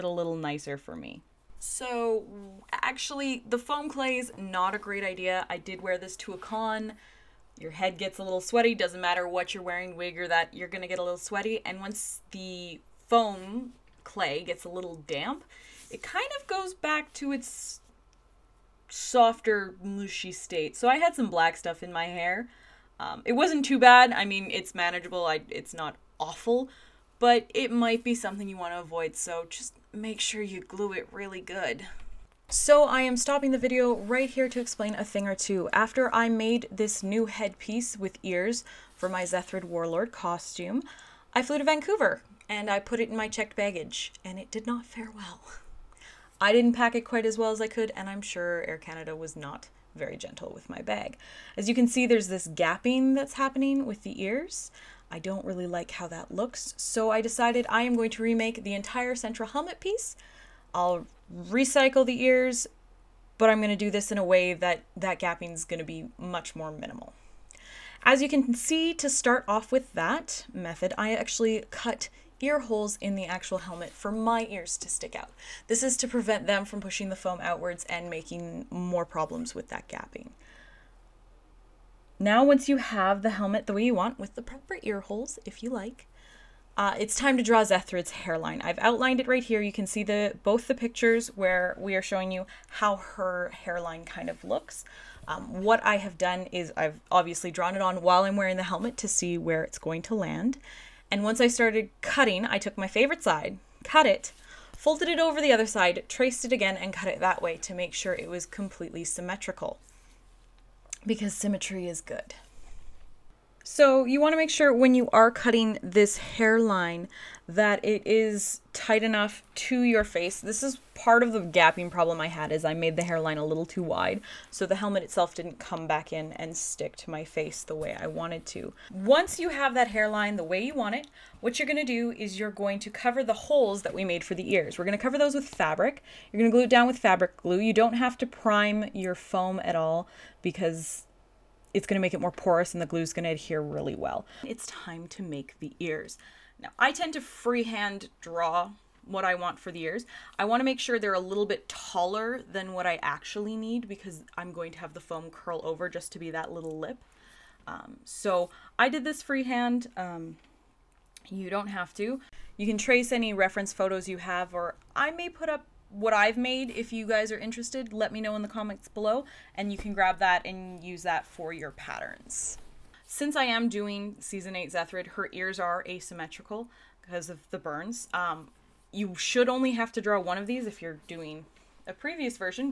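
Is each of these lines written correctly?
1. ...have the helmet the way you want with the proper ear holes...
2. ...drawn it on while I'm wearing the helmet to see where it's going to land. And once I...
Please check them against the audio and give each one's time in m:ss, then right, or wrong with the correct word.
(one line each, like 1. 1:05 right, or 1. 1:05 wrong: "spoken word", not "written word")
1. 1:22 right
2. 1:37 right.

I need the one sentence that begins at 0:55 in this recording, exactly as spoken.
I don't really like how that looks, so I decided I am going to remake the entire central helmet piece.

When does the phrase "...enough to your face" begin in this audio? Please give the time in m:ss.
1:59.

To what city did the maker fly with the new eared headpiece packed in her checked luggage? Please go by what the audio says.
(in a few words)
Vancouver.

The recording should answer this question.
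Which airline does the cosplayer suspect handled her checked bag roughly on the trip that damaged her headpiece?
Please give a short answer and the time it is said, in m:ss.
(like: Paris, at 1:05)
Air Canada, at 0:48.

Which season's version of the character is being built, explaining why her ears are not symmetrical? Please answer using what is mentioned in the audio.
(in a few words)
season 8.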